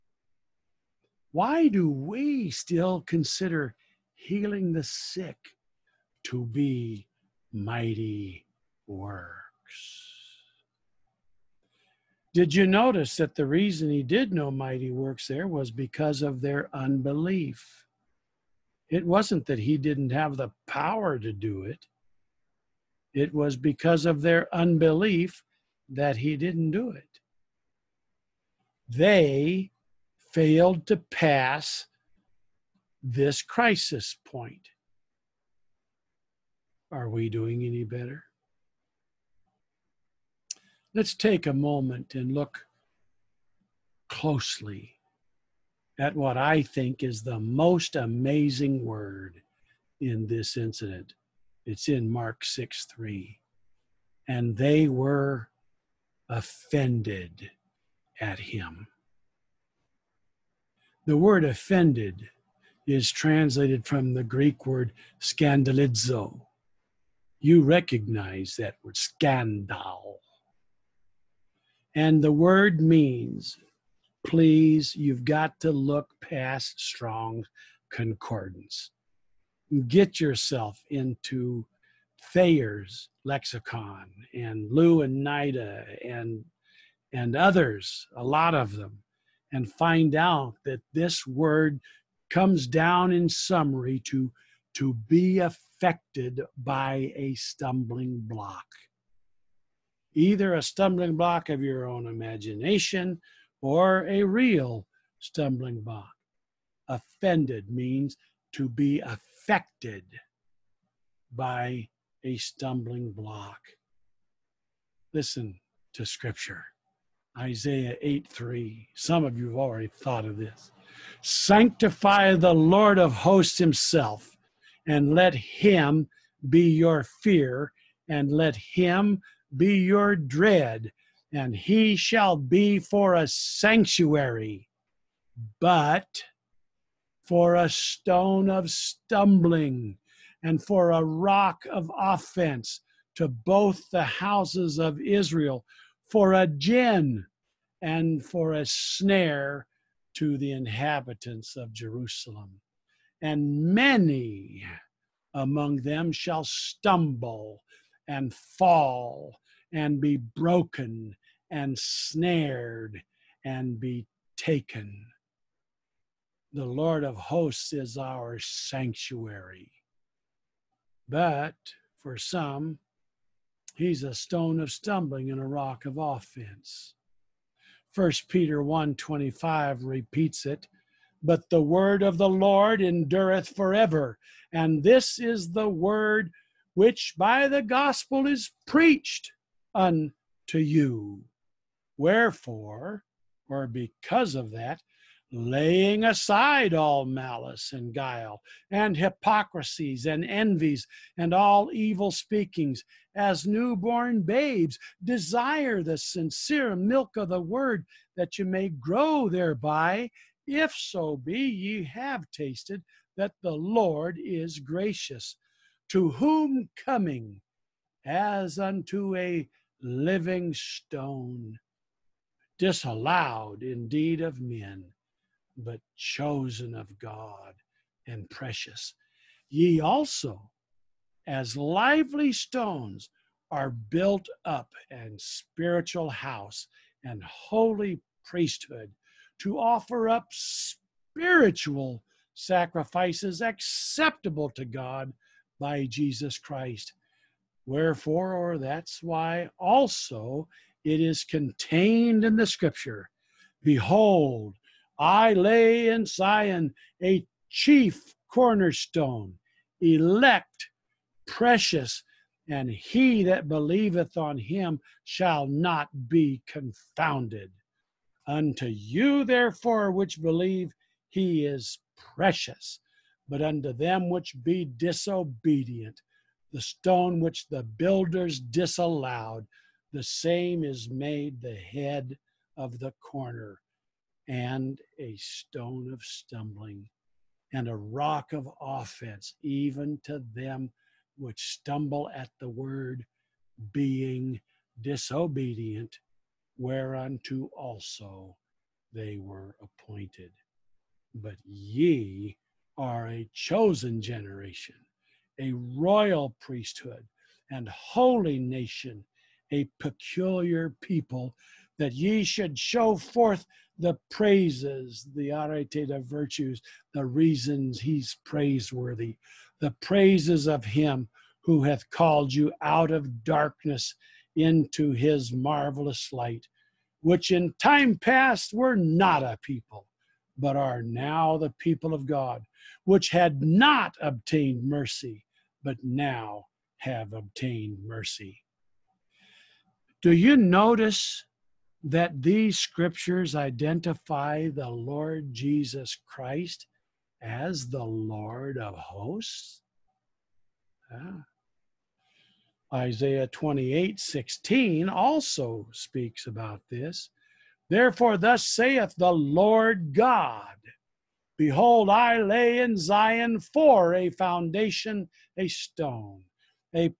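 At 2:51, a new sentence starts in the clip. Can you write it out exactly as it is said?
But for some, he's a stone of stumbling and a rock of offense.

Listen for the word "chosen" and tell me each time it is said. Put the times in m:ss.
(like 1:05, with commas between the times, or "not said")
3:45, 5:03.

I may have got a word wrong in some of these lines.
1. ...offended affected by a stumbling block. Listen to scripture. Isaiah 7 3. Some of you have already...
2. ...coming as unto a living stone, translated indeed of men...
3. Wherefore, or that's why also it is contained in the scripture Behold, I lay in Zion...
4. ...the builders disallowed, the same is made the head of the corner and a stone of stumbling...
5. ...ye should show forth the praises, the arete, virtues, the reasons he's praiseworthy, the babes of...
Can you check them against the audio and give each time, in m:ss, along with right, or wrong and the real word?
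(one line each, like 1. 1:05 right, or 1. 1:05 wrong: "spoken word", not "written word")
1. 1:48 wrong: "8", not "7"
2. 3:36 wrong: "disallowed", not "translated"
3. 4:07 right
4. 4:37 right
5. 5:11 wrong: "praises", not "babes".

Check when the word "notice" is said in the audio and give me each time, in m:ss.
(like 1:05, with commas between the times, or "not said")
0:12, 5:40.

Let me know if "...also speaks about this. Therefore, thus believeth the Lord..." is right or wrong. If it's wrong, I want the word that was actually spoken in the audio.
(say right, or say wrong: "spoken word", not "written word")
wrong: "saith", not "believeth".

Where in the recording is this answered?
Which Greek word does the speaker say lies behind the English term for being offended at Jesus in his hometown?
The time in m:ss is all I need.
1:05.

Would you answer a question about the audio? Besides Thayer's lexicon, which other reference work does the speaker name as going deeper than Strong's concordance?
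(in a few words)
Louw and Nida.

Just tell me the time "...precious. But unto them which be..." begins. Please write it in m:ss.
4:31.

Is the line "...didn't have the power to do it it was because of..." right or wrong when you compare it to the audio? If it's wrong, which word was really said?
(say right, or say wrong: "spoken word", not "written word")
right.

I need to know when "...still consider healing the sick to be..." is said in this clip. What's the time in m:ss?
0:02.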